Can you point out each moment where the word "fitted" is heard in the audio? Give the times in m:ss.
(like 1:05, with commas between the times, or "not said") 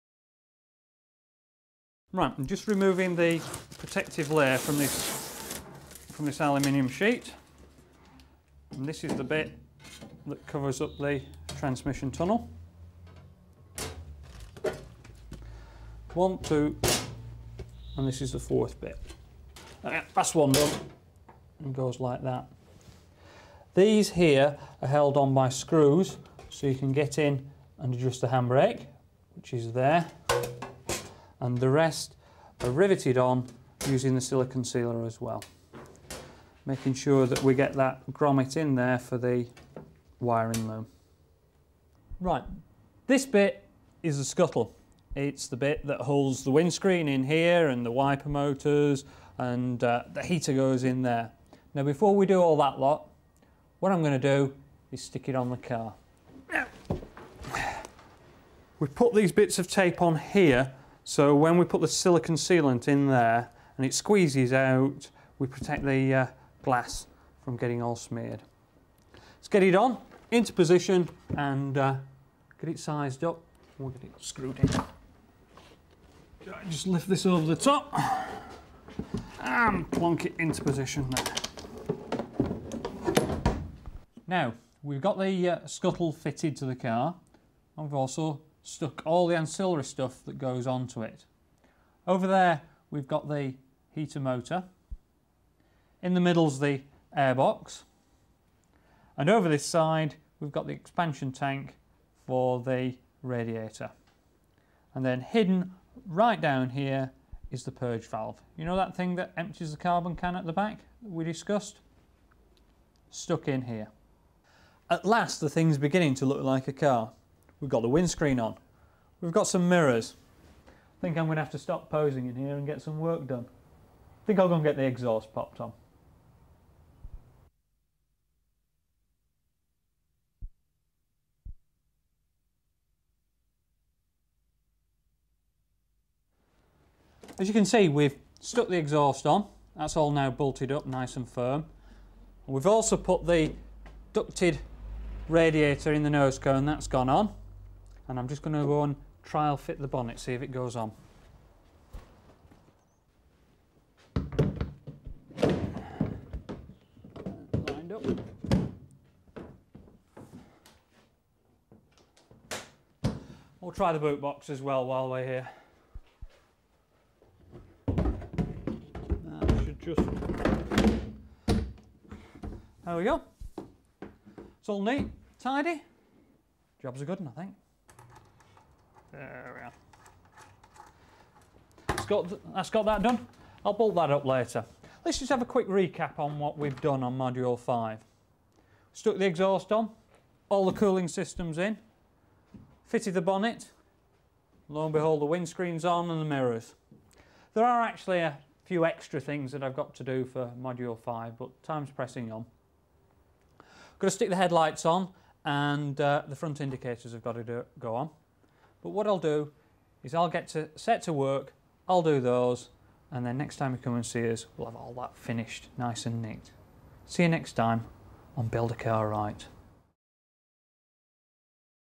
1:26, 3:12.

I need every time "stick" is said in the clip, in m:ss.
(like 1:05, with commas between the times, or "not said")
0:55, 3:24.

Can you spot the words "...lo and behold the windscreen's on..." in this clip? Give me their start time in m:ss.
3:14.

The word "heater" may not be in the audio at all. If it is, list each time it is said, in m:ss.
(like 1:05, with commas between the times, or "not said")
0:50, 1:33.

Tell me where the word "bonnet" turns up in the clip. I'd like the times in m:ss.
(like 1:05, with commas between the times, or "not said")
2:29, 3:13.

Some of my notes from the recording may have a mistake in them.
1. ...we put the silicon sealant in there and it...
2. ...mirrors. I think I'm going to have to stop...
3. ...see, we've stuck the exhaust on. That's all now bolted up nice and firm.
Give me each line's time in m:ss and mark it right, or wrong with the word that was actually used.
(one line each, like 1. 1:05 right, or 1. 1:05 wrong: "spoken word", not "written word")
1. 1:01 right
2. 1:59 right
3. 2:17 right.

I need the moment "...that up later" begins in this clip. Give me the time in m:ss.
3:03.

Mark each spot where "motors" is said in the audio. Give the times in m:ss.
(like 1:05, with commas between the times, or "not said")
0:48, 1:34.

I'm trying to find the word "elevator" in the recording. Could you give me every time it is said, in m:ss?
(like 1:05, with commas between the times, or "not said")
not said.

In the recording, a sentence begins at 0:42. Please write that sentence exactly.
Right, this bit is the scuttle.